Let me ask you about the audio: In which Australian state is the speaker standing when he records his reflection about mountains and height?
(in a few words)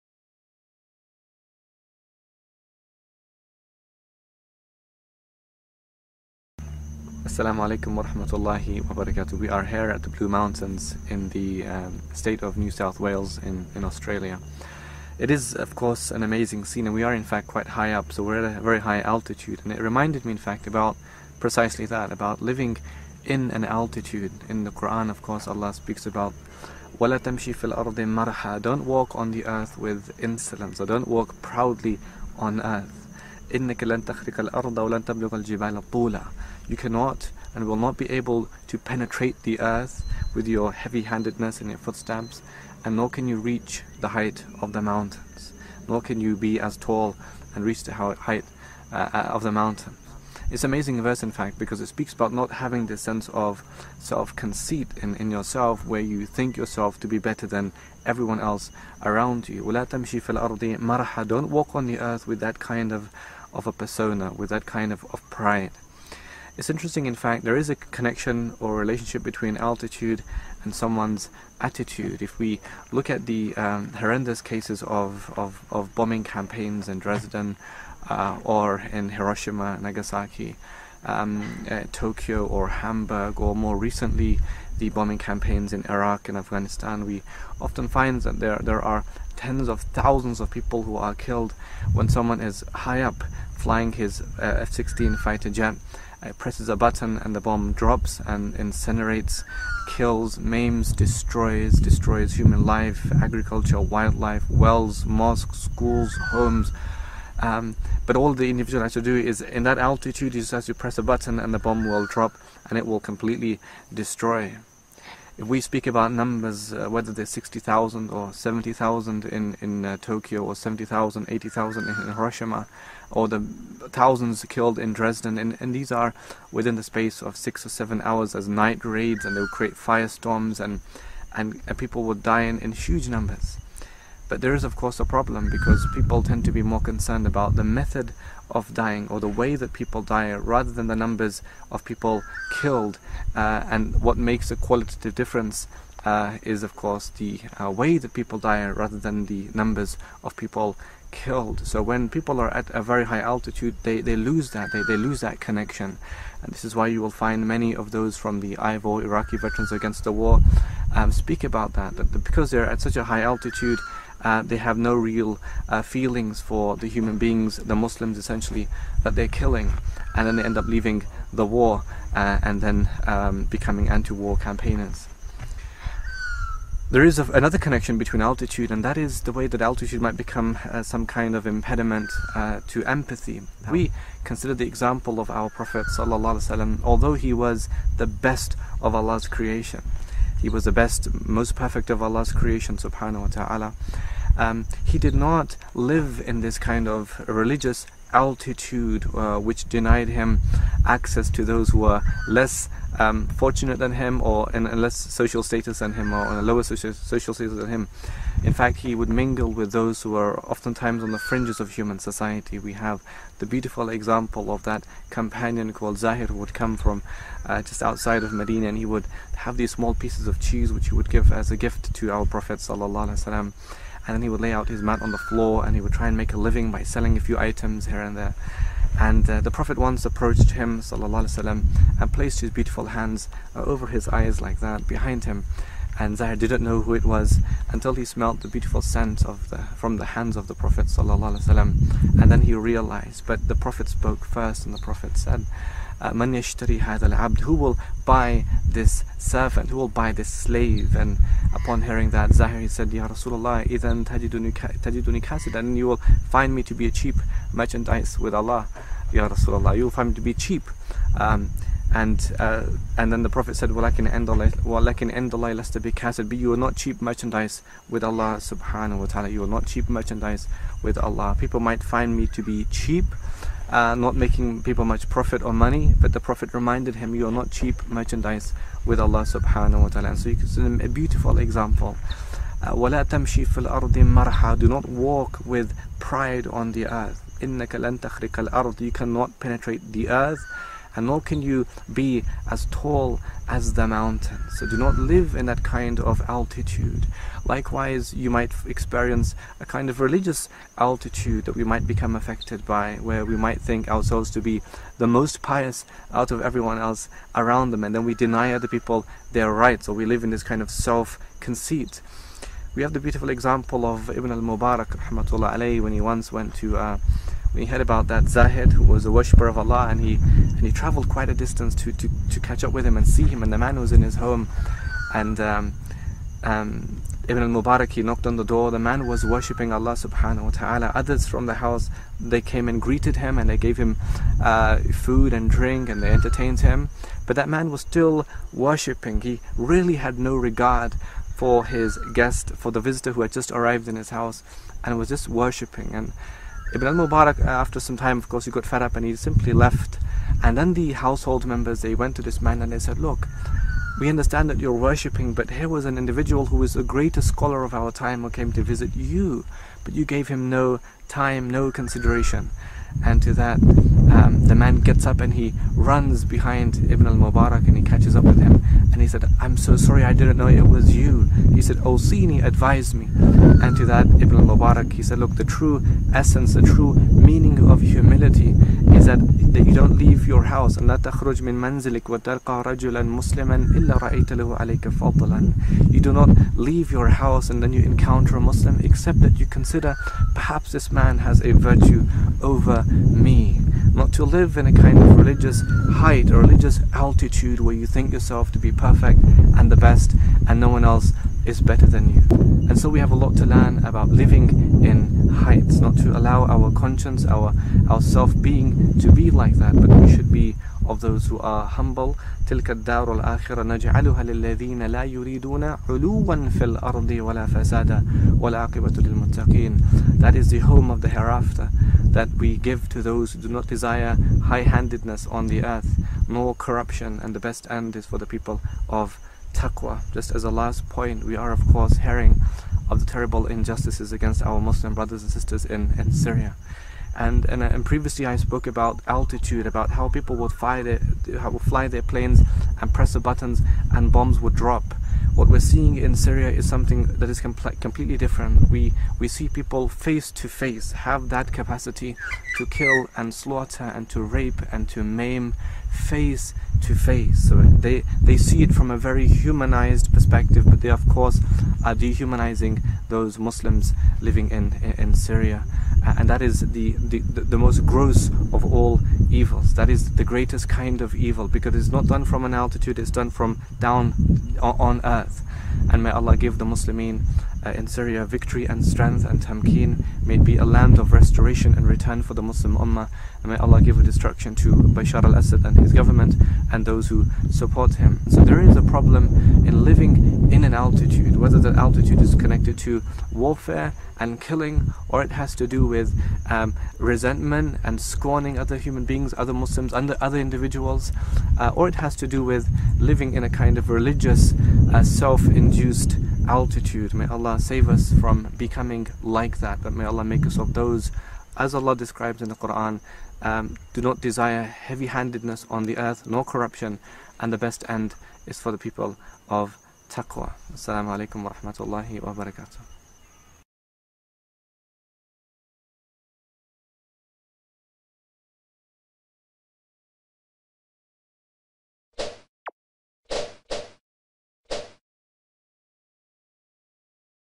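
New South Wales.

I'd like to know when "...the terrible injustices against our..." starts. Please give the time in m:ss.
7:12.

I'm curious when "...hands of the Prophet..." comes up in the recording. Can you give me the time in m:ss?
4:00.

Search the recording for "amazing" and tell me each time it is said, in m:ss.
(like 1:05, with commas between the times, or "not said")
0:16, 0:50.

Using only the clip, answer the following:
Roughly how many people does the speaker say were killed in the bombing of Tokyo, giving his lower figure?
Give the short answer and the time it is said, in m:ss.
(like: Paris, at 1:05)
60,000, at 1:57.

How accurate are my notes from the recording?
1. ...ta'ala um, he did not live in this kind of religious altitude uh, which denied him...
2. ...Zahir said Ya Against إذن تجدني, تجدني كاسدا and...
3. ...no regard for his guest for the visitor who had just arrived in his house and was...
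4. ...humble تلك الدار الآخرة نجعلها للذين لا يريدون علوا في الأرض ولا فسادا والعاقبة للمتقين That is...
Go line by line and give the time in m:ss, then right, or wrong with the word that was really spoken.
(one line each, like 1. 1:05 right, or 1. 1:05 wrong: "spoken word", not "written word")
1. 3:13 right
2. 4:12 wrong: "Rasulullah", not "Against"
3. 5:40 right
4. 6:51 right.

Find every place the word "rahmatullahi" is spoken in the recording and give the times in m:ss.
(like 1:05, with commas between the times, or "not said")
0:08, 8:41.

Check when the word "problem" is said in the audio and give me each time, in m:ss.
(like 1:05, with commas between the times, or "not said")
2:15, 8:08.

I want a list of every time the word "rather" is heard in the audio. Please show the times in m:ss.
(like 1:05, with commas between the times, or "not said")
2:20, 2:28.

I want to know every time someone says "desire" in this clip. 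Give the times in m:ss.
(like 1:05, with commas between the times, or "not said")
7:03, 8:34.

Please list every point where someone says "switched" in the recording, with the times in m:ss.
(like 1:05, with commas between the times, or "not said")
not said.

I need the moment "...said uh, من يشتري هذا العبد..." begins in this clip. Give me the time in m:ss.
4:05.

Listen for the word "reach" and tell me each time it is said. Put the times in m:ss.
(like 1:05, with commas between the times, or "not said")
0:43, 0:47.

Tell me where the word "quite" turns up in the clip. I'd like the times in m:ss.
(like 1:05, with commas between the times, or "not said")
0:17, 5:21.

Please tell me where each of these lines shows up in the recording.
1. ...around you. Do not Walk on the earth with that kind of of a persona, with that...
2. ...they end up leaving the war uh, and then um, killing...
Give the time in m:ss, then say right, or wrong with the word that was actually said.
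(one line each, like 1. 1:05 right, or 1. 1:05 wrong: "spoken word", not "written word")
1. 0:59 right
2. 2:50 wrong: "becoming", not "killing".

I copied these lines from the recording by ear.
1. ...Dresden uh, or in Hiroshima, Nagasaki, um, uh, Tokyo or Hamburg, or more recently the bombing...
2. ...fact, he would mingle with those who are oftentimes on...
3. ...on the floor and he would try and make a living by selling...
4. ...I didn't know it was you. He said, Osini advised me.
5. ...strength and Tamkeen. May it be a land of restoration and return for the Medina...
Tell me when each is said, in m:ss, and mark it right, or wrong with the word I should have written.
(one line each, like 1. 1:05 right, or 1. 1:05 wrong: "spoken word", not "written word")
1. 1:16 right
2. 3:28 right
3. 3:45 right
4. 6:10 right
5. 7:58 wrong: "Muslim", not "Medina".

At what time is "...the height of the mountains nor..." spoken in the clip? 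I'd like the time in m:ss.
0:43.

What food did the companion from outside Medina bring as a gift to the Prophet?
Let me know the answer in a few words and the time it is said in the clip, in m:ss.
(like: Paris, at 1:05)
Cheese, at 3:40.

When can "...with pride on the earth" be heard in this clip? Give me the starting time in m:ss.
4:45.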